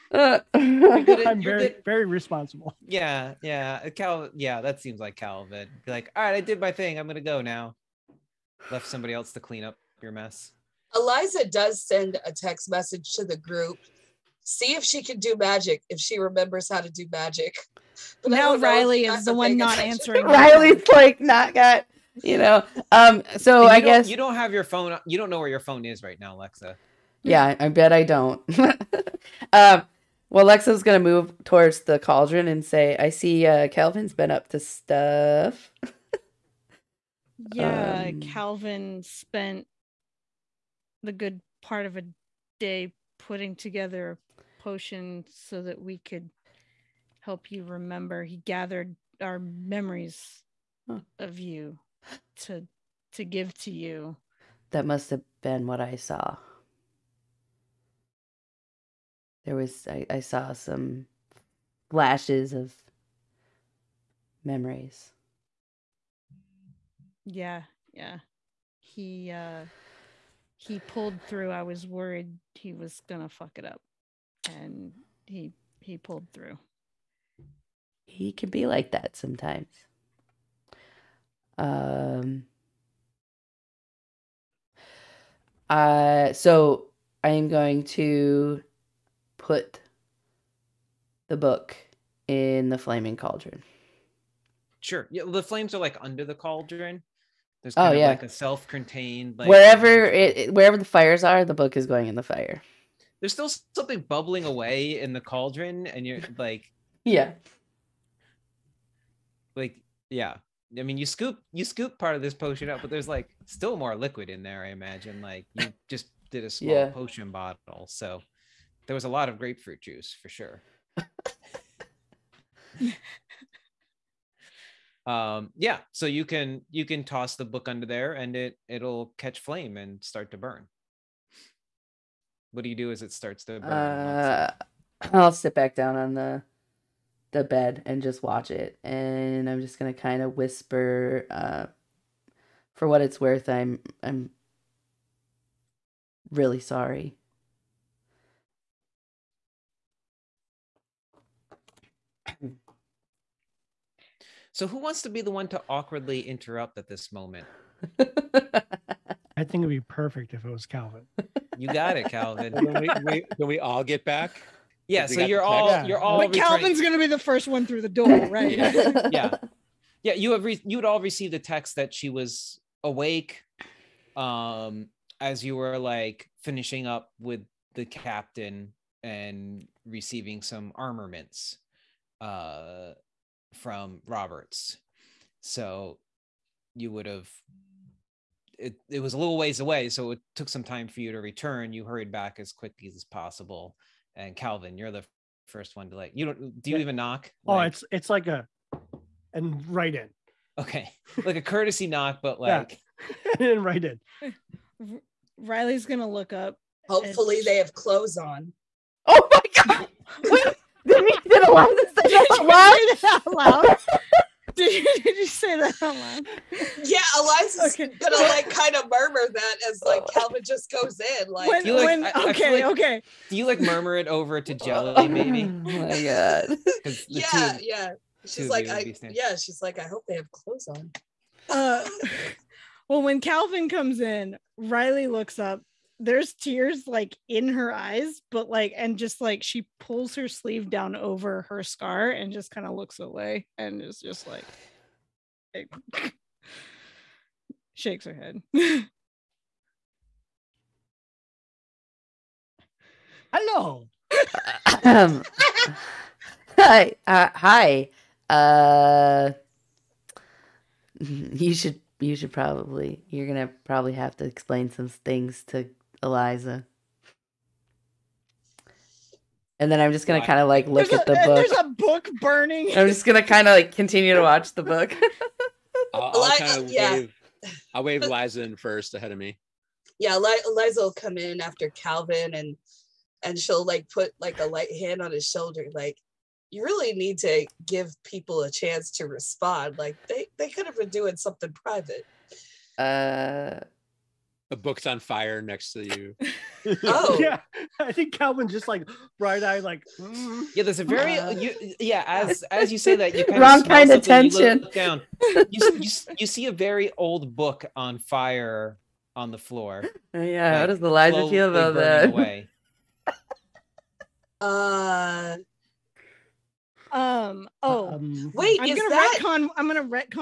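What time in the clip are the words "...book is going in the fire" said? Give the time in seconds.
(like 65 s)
101 s.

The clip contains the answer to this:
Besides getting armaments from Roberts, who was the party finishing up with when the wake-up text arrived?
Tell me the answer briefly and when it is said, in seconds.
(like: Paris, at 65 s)
the captain, at 177 s.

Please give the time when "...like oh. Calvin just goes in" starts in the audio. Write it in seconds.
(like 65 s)
219 s.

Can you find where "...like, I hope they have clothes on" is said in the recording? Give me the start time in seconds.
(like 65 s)
229 s.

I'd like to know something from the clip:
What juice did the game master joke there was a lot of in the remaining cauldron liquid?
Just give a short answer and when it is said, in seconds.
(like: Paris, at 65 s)
grapefruit juice, at 119 s.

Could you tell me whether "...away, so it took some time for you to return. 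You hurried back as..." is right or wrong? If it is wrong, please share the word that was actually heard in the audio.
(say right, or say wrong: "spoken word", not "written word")
right.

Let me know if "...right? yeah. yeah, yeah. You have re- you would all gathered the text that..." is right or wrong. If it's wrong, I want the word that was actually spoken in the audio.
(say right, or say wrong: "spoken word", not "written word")
wrong: "received", not "gathered".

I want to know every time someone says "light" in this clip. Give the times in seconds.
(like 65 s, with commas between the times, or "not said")
284 s.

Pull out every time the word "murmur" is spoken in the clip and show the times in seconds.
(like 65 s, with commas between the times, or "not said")
218 s, 223 s.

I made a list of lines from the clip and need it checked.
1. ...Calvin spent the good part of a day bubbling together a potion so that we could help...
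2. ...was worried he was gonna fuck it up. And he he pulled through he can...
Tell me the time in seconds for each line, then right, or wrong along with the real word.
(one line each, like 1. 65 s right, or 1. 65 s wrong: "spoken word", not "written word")
1. 38 s wrong: "putting", not "bubbling"
2. 71 s right.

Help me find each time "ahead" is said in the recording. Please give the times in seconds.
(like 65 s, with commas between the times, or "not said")
278 s.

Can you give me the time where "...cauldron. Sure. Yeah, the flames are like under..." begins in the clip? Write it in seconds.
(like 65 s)
93 s.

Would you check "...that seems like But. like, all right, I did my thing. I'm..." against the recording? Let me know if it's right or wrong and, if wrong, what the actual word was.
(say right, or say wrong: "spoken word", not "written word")
wrong: "Calvin", not "But".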